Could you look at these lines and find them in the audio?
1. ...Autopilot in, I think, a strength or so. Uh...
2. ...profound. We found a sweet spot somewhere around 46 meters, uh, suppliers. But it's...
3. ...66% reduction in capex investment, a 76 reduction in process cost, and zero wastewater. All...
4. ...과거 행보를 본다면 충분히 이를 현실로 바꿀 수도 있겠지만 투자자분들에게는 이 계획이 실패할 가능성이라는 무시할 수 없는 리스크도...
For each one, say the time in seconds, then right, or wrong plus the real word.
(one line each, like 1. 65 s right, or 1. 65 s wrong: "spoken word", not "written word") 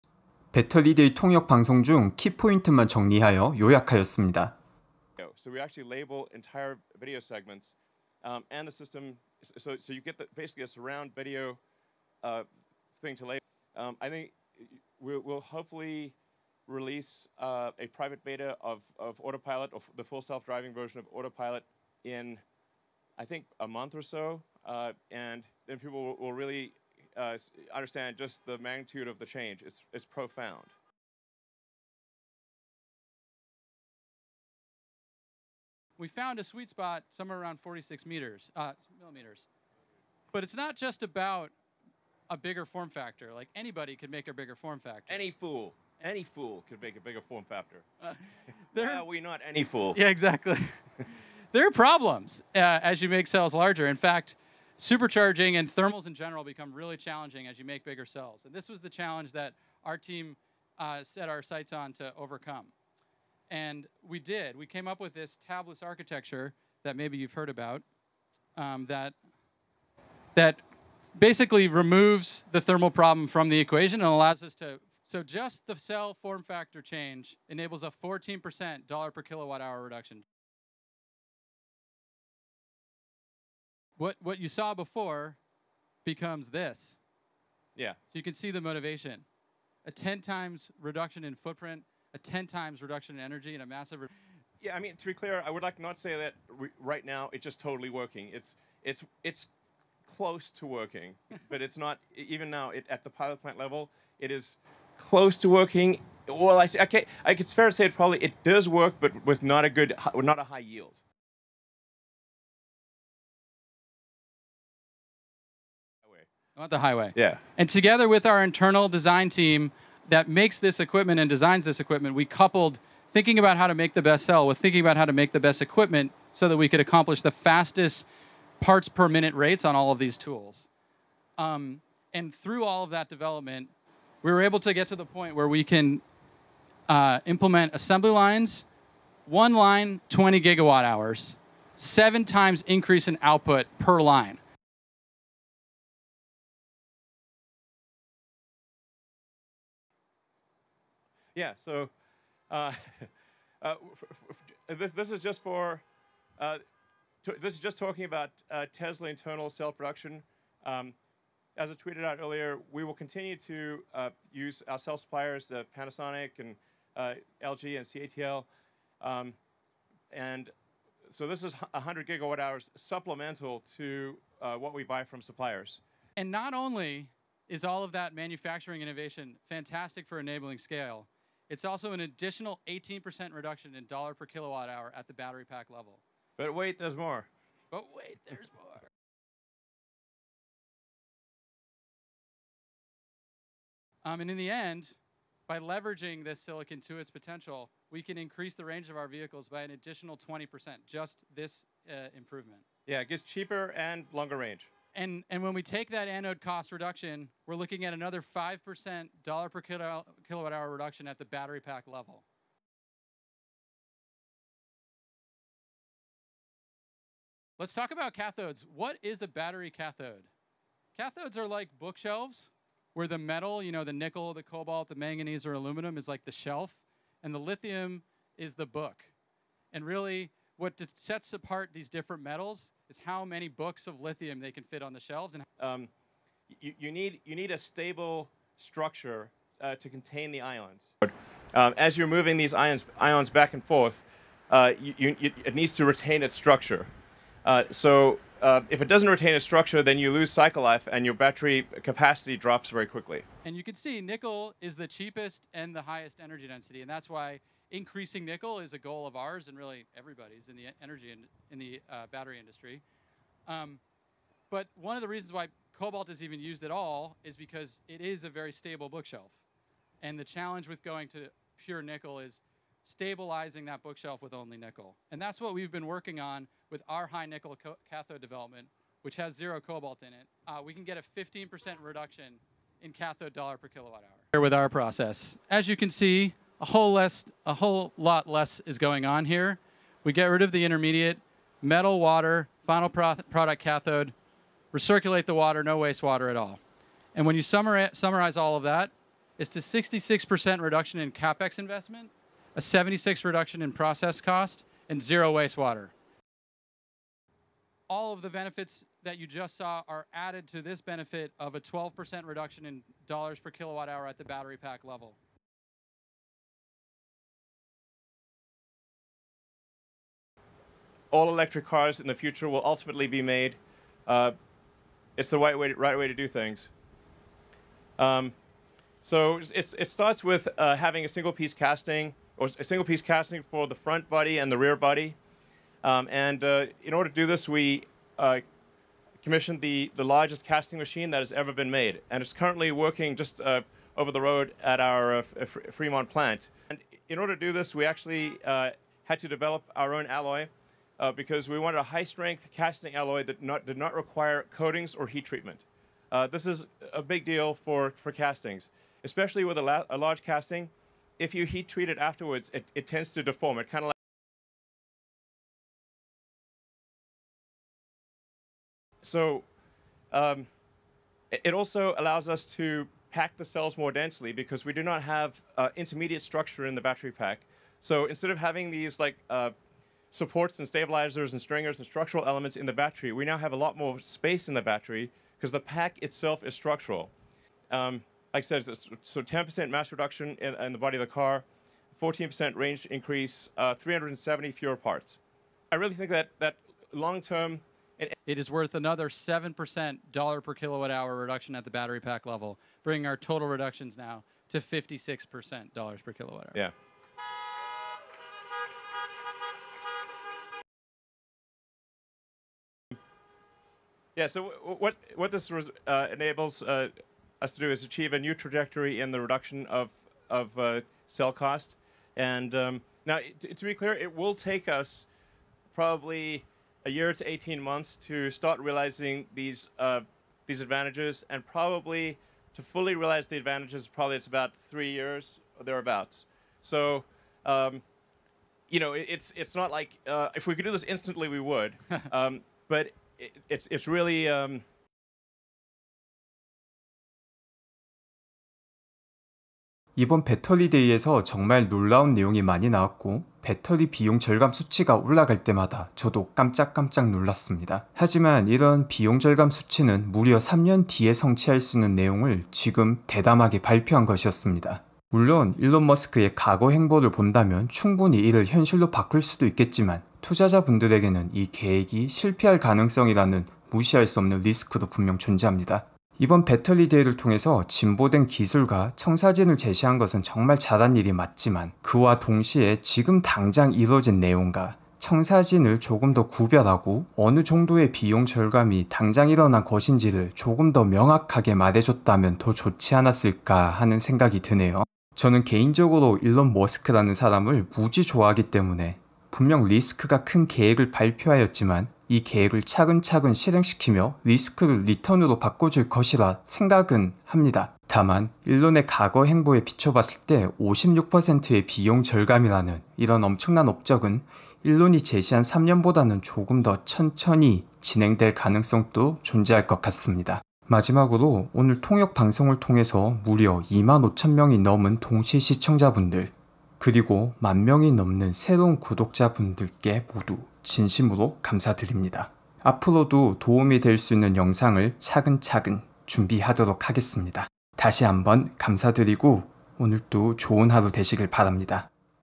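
1. 21 s wrong: "month", not "strength"
2. 30 s wrong: "millimeters", not "suppliers"
3. 299 s right
4. 466 s right.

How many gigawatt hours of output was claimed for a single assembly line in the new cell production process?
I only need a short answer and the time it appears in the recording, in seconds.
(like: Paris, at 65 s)
20 gigawatt hours, at 140 s.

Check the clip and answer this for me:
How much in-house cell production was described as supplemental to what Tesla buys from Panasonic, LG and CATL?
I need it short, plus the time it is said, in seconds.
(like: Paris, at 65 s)
100 gigawatt hours, at 171 s.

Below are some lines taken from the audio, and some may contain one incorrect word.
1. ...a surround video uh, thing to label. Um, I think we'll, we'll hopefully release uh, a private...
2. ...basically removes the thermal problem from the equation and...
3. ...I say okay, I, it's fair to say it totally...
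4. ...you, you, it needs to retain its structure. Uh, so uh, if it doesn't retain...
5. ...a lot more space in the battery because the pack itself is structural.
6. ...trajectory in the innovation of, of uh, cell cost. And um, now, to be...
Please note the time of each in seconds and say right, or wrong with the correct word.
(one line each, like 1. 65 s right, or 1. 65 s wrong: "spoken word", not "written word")
1. 10 s right
2. 71 s right
3. 106 s wrong: "probably", not "totally"
4. 244 s right
5. 383 s right
6. 418 s wrong: "reduction", not "innovation".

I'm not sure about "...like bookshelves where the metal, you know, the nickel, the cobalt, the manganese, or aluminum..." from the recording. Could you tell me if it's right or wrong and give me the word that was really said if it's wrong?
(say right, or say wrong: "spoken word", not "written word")
right.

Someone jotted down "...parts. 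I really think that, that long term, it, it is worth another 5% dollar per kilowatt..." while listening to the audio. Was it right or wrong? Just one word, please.
wrong.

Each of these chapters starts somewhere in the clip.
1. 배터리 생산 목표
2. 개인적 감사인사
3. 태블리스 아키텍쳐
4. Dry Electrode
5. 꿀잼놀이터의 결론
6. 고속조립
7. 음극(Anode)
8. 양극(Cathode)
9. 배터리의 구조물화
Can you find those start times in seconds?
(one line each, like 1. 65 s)
1. 147 s
2. 520 s
3. 33 s
4. 82 s
5. 447 s
6. 113 s
7. 191 s
8. 216 s
9. 366 s.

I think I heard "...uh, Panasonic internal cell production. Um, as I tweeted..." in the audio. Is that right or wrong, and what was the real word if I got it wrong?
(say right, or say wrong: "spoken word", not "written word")
wrong: "Tesla", not "Panasonic".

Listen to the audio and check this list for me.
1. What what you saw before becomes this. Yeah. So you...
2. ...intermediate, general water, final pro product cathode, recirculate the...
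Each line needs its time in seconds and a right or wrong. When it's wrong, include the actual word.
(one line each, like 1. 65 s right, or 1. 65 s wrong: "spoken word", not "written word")
1. 84 s right
2. 290 s wrong: "metal", not "general".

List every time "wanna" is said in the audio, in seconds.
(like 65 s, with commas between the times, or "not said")
not said.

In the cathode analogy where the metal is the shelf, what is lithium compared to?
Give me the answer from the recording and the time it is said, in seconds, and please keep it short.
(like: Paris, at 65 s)
the book, at 228 s.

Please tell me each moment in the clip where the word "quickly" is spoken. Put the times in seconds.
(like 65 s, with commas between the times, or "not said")
252 s.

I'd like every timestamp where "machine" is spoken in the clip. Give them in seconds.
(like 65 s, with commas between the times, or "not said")
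340 s.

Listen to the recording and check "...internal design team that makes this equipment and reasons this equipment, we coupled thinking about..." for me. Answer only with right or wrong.
wrong.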